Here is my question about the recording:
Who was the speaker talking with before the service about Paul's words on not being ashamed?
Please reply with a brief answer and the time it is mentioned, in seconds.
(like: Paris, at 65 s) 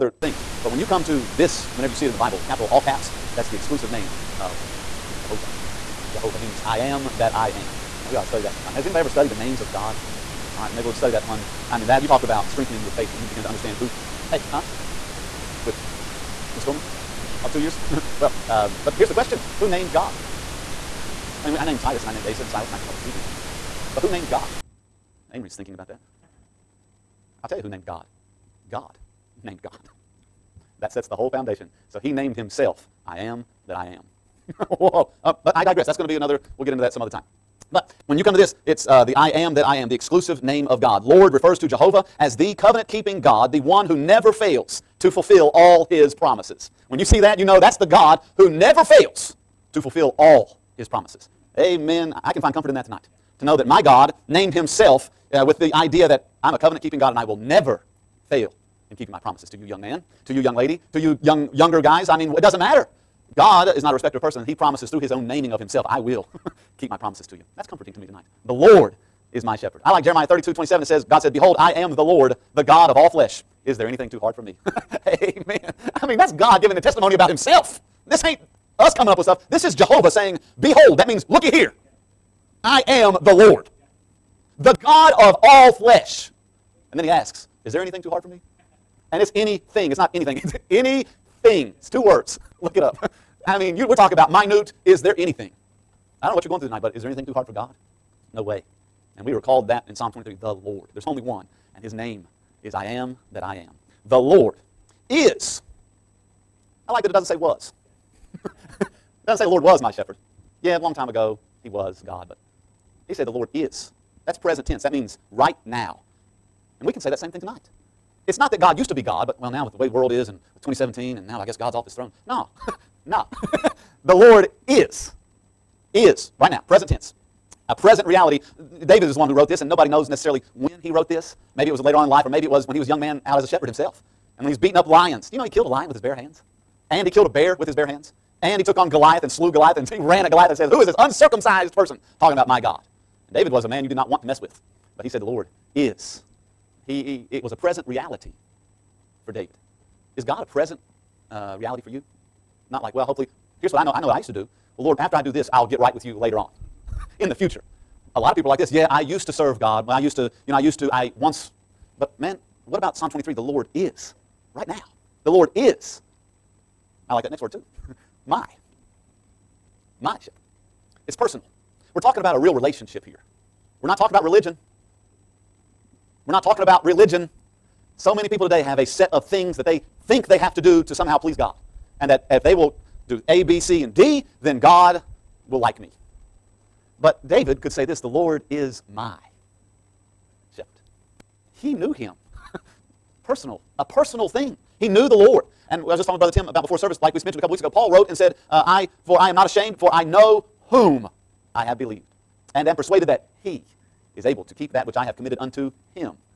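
Brother Tim, at 196 s.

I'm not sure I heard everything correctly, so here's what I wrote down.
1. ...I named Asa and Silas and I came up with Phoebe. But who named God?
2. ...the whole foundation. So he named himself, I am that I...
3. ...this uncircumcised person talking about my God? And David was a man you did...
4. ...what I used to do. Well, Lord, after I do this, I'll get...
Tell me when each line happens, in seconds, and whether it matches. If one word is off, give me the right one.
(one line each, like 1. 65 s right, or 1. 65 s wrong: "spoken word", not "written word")
1. 22 s right
2. 31 s right
3. 140 s right
4. 154 s right.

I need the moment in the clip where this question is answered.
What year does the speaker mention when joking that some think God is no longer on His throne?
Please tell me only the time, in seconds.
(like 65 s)
120 s.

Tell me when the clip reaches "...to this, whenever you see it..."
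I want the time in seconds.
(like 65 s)
1 s.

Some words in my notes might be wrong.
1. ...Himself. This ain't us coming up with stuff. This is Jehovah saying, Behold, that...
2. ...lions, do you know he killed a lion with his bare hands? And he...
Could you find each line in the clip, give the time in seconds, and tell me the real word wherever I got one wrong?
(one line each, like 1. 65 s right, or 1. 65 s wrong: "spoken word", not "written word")
1. 77 s right
2. 134 s right.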